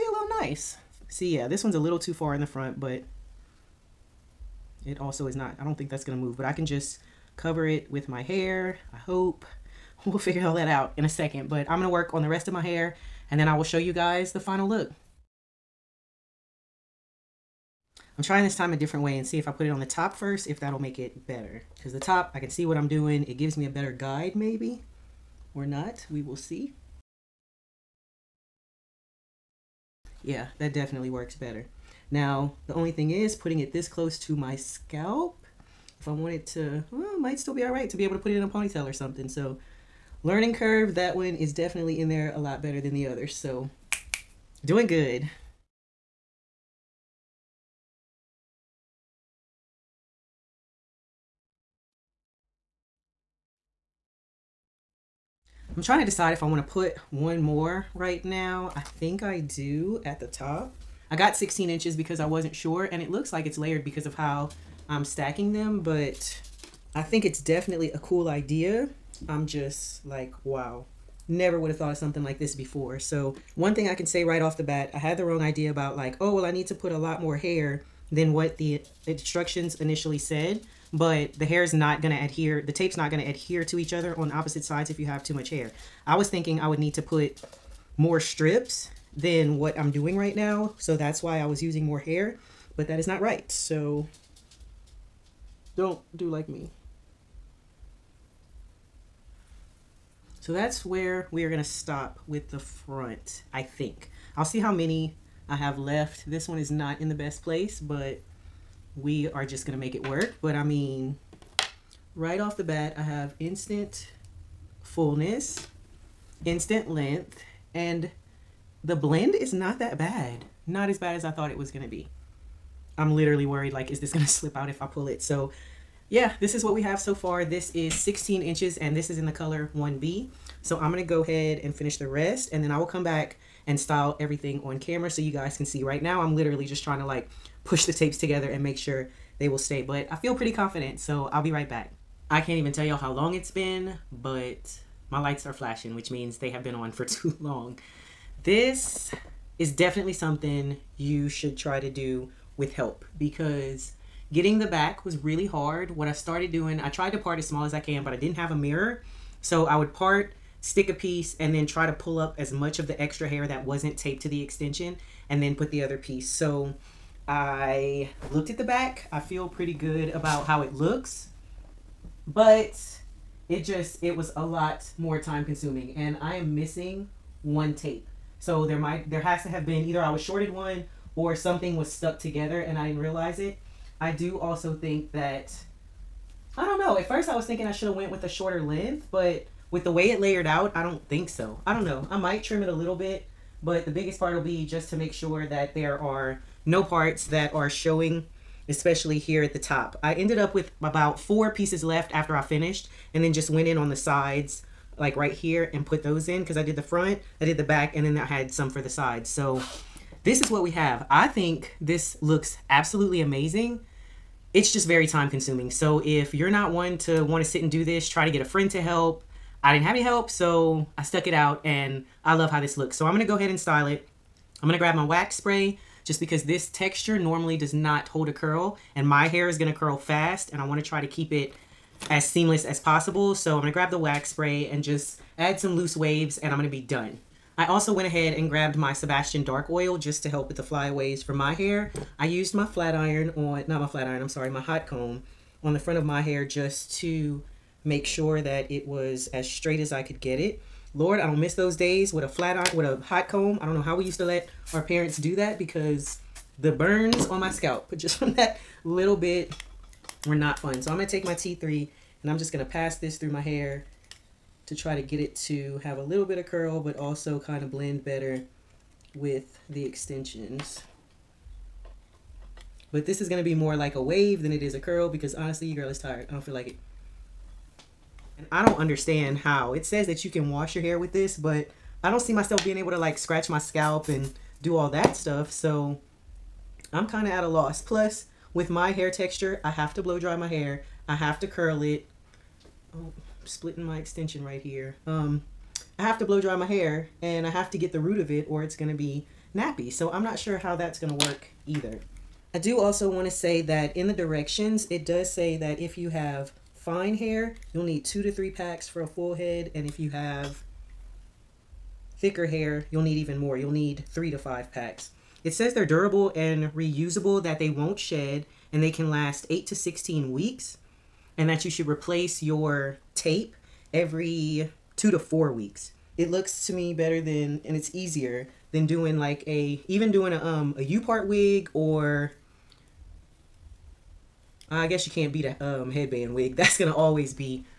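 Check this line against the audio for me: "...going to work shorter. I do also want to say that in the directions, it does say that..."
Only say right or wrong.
wrong.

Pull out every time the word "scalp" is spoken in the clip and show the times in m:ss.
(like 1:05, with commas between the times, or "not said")
0:34, 4:17, 4:43.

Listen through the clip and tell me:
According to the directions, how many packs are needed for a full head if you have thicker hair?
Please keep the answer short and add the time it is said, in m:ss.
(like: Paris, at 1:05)
3 to 5 packs, at 5:14.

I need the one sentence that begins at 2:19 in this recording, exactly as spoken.
But I feel pretty confident so I'll be right back.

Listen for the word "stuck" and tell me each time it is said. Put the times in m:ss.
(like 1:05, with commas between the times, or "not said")
3:01, 3:41.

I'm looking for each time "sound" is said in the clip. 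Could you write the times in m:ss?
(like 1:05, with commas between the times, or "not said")
not said.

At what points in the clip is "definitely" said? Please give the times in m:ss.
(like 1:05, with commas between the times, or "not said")
0:30, 0:41, 1:07, 2:29.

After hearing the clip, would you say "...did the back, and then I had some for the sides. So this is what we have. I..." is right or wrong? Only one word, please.
right.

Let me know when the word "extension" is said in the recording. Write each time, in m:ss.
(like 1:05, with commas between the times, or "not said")
2:44, 4:29, 4:53.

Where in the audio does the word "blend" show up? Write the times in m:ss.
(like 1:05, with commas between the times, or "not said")
1:58, 4:27.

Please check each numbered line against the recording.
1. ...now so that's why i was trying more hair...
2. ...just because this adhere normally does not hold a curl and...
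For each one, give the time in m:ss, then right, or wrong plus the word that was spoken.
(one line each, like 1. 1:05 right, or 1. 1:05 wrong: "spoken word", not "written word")
1. 1:30 wrong: "using", not "trying"
2. 3:46 wrong: "texture", not "adhere".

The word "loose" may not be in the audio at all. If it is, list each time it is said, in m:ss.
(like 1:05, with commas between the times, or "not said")
3:55.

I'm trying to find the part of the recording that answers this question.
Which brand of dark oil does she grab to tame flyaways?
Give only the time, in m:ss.
3:58.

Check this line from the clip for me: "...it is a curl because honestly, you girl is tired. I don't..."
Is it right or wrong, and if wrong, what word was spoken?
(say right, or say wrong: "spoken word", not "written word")
right.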